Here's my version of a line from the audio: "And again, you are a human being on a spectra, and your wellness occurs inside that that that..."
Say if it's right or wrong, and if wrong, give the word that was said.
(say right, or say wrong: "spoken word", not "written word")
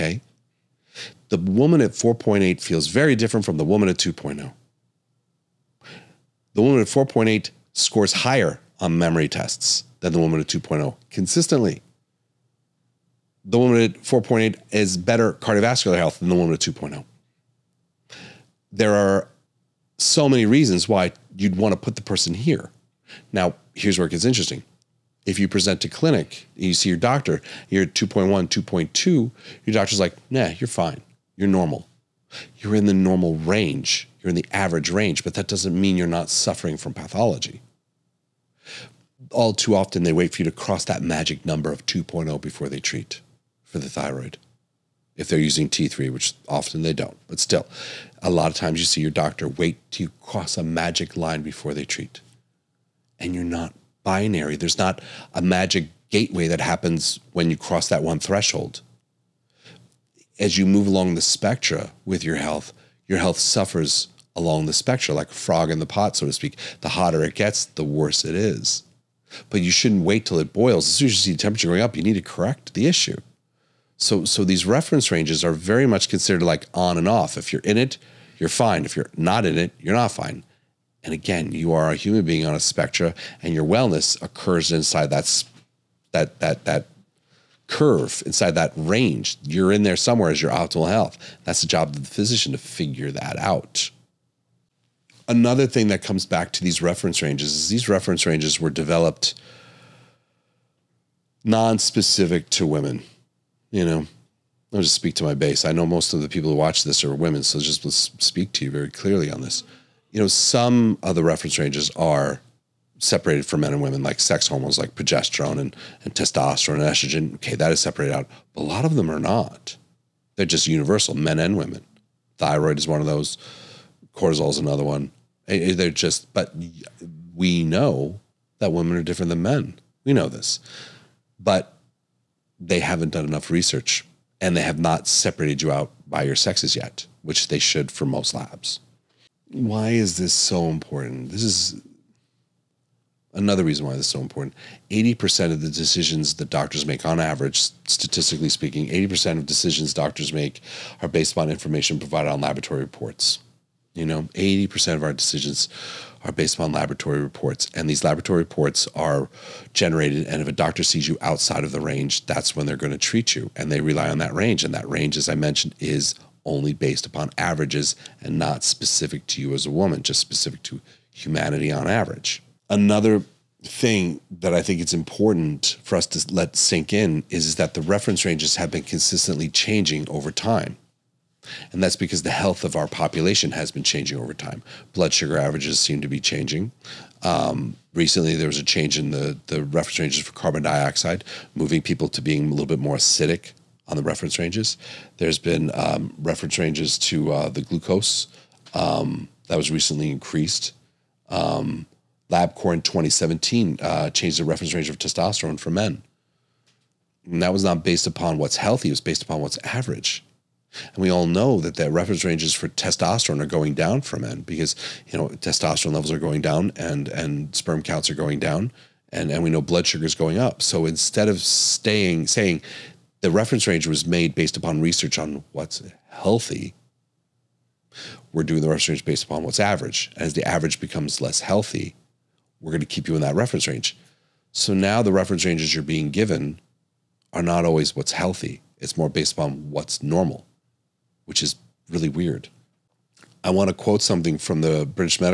right.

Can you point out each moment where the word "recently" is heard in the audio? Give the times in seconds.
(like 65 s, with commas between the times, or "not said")
187 s, 199 s.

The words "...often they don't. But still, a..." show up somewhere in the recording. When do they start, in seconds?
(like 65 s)
46 s.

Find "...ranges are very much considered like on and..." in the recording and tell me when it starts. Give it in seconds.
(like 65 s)
75 s.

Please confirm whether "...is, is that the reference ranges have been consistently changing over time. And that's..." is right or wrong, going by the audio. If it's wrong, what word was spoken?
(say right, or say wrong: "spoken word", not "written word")
right.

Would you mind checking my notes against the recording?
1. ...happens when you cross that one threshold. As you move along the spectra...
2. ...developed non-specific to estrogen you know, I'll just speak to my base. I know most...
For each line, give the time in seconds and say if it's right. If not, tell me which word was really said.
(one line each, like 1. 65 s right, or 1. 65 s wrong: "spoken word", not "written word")
1. 56 s right
2. 98 s wrong: "women", not "estrogen".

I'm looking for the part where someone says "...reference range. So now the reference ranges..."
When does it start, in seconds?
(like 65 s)
233 s.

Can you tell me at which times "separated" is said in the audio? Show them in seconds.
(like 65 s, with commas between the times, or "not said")
112 s, 117 s, 135 s.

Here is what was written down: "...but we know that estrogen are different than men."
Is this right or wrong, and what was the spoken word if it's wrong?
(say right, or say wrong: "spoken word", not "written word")
wrong: "women", not "estrogen".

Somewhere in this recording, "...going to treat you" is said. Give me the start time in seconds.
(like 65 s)
162 s.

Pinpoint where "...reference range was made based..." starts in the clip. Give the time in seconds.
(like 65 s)
223 s.